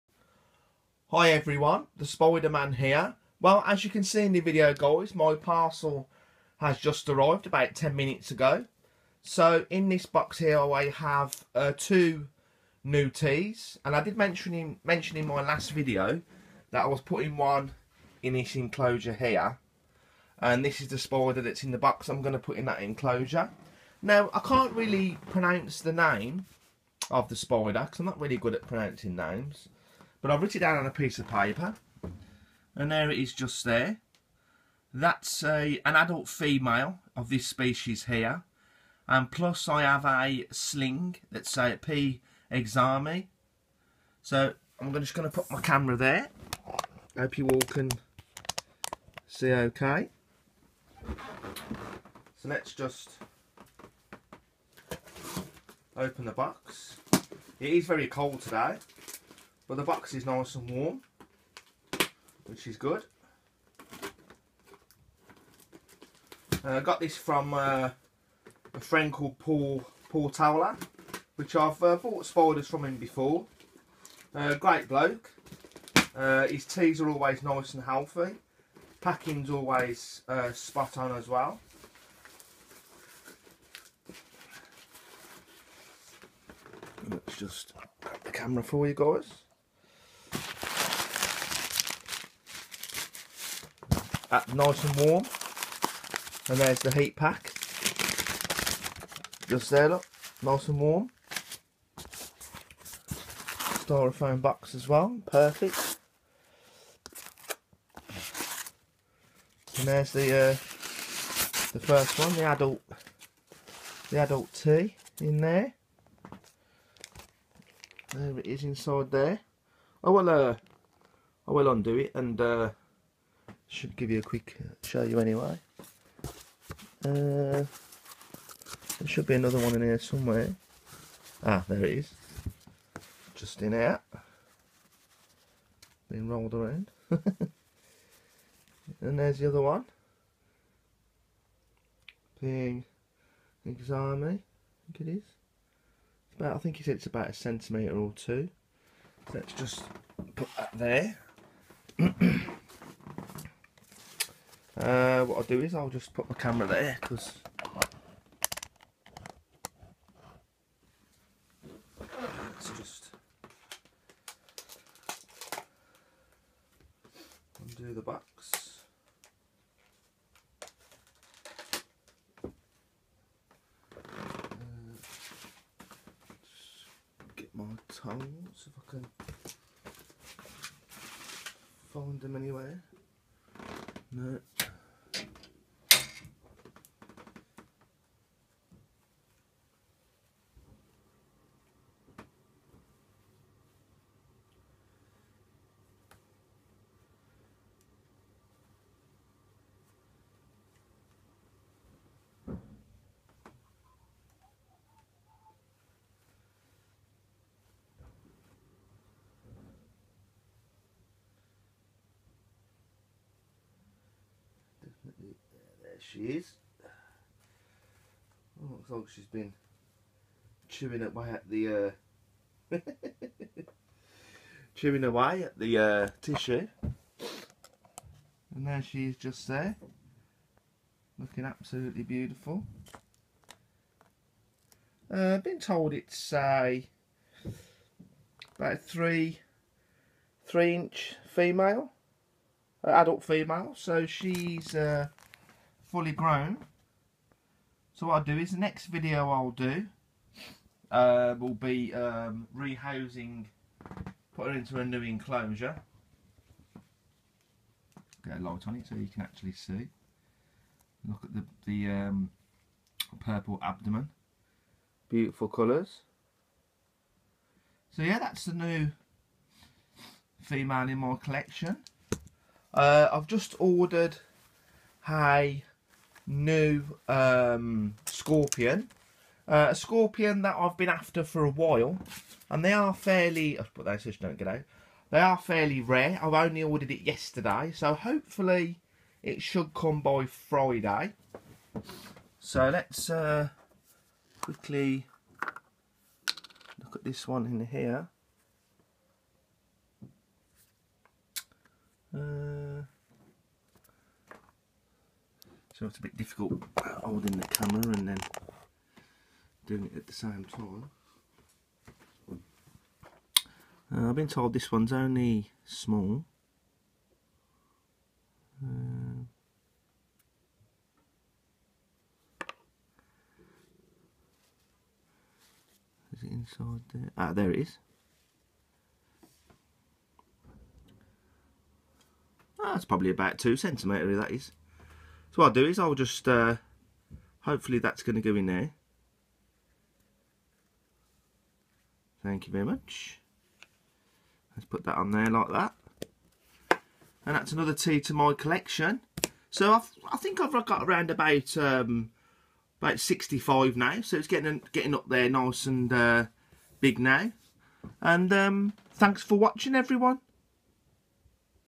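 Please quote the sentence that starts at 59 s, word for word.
But the box is nice and warm, which is good.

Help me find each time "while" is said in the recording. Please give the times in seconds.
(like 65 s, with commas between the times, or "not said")
281 s.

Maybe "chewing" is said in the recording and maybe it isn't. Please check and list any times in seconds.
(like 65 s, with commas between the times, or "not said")
220 s, 224 s.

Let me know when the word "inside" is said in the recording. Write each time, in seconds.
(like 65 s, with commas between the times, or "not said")
118 s, 326 s.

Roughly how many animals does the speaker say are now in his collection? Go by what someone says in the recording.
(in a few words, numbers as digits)
65.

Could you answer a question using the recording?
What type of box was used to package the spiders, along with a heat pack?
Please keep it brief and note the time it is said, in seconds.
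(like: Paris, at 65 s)
Styrofoam box, at 103 s.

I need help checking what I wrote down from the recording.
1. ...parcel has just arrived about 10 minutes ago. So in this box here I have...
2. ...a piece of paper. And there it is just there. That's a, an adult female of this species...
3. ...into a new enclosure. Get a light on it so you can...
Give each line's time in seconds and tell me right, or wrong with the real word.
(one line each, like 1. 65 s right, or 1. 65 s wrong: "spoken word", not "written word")
1. 5 s right
2. 30 s right
3. 254 s right.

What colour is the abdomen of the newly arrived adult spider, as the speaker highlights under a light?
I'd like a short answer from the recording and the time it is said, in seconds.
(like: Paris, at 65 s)
Purple, at 263 s.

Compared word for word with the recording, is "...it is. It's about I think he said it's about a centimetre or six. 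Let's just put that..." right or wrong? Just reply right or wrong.
wrong.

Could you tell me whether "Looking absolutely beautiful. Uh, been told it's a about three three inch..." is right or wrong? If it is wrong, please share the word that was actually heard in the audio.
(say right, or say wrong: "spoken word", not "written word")
right.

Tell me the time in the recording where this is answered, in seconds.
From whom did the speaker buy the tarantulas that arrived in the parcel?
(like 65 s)
70 s.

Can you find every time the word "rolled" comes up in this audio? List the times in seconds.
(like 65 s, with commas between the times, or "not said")
136 s.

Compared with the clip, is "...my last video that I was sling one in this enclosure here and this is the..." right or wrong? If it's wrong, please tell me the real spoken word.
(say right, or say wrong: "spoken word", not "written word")
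wrong: "putting", not "sling".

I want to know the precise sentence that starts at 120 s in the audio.
I will uh I will undo it and uh should give you a quick uh, show you anyway.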